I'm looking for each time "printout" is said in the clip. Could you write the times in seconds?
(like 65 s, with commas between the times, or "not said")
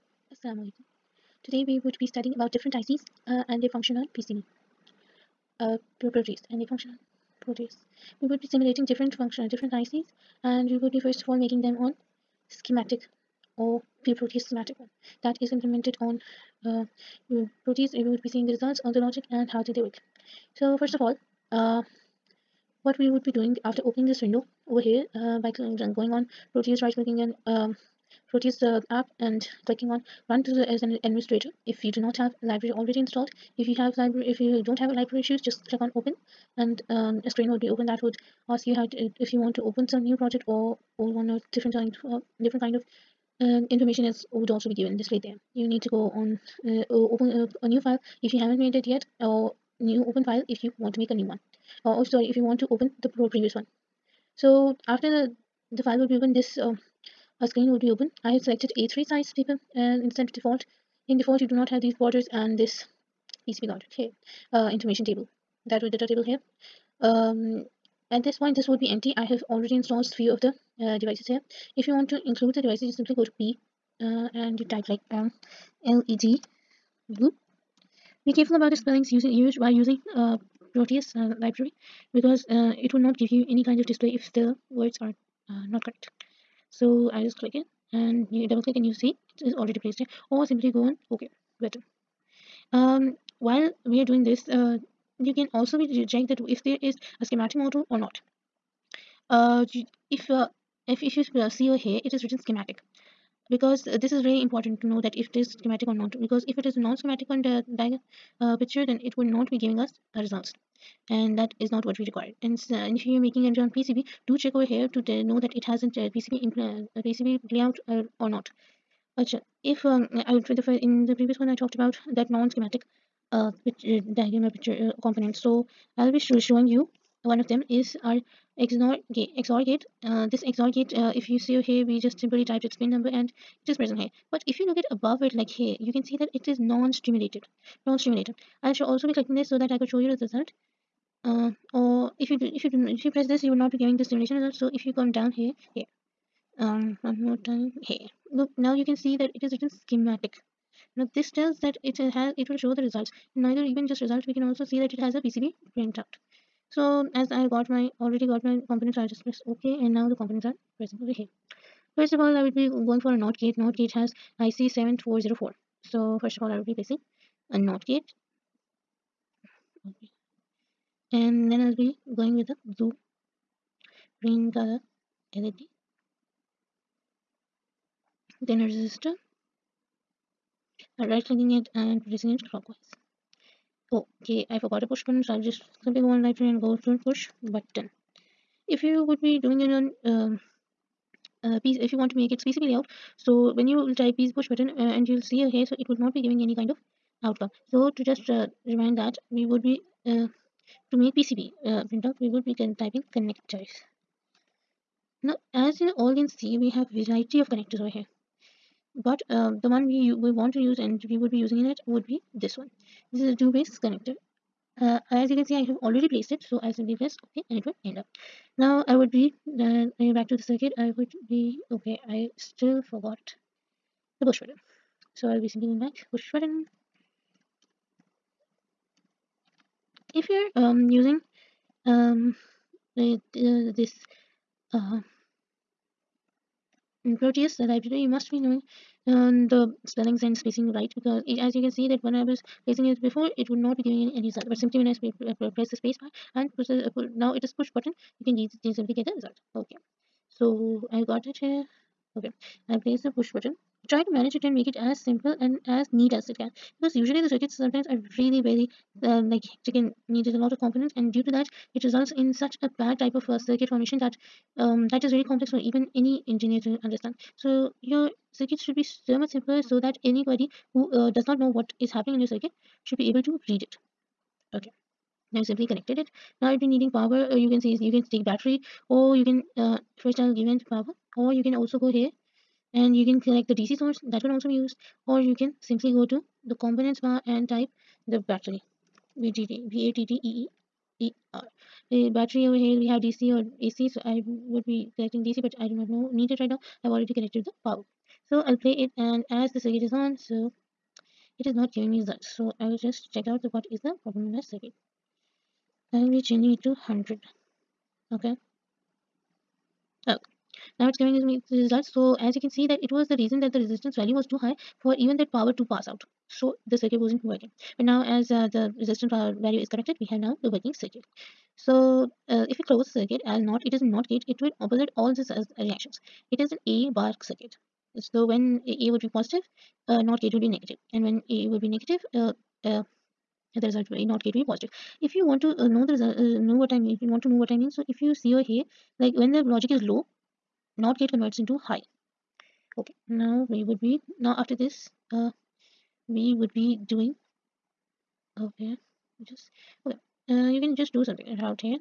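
155 s, 201 s.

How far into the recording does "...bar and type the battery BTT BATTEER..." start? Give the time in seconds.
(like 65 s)
286 s.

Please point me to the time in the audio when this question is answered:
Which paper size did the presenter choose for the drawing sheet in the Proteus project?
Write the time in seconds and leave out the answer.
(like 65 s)
58 s.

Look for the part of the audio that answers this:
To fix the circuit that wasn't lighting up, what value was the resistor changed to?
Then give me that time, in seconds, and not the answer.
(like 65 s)
306 s.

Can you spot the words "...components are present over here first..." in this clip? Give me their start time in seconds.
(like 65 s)
160 s.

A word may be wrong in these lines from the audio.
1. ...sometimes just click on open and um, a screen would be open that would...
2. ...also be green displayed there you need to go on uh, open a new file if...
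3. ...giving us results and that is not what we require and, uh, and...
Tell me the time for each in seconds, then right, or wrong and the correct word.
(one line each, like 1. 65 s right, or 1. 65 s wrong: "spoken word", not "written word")
1. 35 s wrong: "issues", not "sometimes"
2. 44 s wrong: "given", not "green"
3. 109 s right.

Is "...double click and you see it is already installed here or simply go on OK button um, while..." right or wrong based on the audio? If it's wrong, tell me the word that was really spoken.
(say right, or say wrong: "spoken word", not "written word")
wrong: "placed", not "installed".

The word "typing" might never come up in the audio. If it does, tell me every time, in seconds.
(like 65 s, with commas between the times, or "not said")
202 s.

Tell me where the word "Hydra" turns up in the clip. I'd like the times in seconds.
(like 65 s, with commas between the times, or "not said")
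not said.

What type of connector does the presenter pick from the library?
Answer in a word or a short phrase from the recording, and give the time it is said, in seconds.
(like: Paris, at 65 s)
two-way connector, at 213 s.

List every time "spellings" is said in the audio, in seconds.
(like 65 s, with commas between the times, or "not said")
78 s, 239 s.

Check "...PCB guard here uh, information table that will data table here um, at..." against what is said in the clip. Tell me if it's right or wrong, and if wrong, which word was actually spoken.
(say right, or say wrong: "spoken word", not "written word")
right.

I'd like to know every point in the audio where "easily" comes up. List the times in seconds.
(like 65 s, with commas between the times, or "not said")
248 s.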